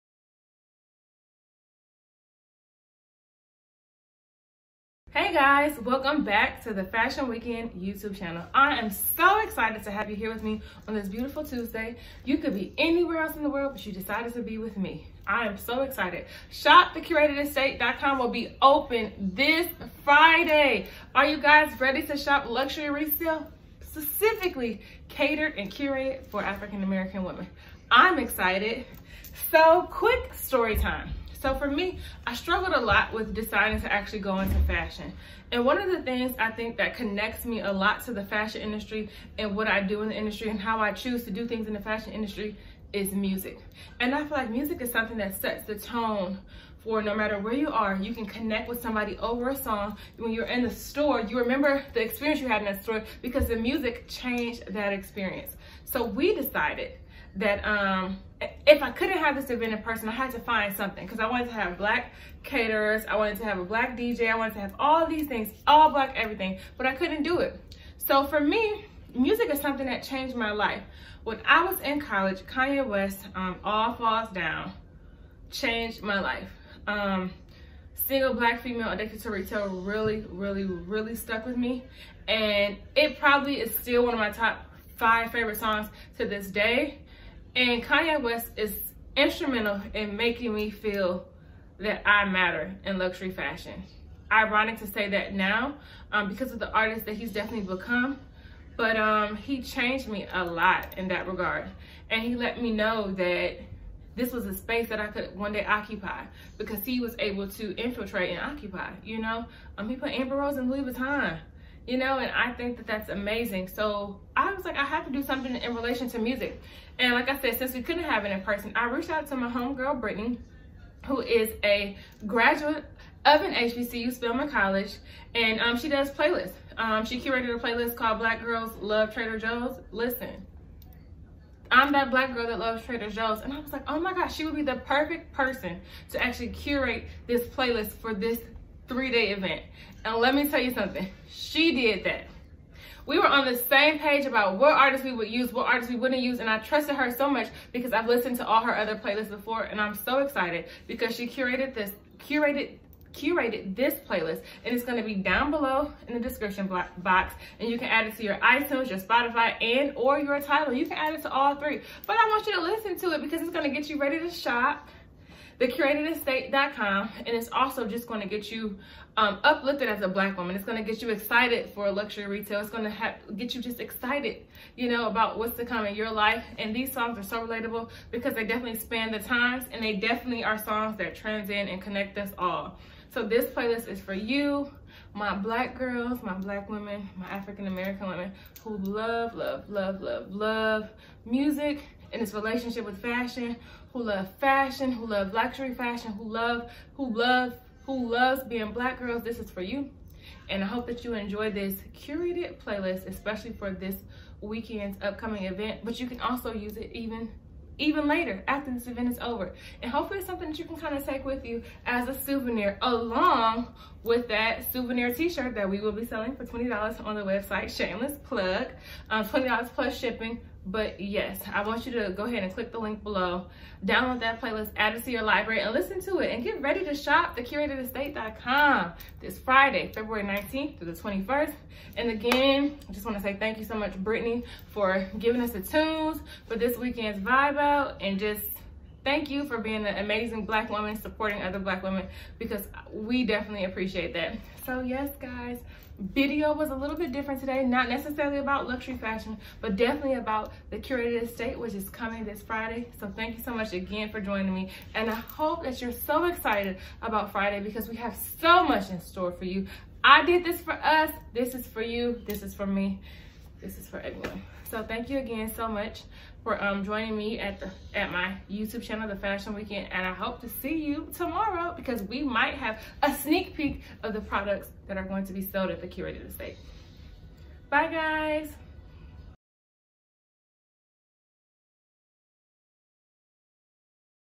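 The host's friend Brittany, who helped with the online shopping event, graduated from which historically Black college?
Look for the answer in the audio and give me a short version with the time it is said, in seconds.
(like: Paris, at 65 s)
Spelman College, at 124 s.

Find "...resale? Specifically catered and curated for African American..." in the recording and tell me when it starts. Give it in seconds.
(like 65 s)
22 s.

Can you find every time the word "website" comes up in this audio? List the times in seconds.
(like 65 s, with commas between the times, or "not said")
217 s.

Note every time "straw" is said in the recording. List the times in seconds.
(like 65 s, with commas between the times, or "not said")
not said.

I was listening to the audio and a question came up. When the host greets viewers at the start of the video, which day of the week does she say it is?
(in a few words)
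Tuesday.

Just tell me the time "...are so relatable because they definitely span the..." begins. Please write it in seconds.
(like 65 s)
177 s.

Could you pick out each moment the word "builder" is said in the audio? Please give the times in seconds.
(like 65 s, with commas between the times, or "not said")
not said.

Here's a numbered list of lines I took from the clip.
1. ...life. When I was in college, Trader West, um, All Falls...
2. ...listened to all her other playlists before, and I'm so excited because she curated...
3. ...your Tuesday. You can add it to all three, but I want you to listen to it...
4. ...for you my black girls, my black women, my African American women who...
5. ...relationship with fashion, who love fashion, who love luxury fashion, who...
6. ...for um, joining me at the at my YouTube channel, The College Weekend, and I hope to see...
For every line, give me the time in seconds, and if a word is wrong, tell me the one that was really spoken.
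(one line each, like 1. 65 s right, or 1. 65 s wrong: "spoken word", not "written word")
1. 70 s wrong: "Kanye", not "Trader"
2. 148 s right
3. 160 s wrong: "Tidal", not "Tuesday"
4. 184 s right
5. 192 s right
6. 266 s wrong: "Fashion", not "College".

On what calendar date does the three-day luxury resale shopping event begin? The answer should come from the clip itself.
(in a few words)
February 19th.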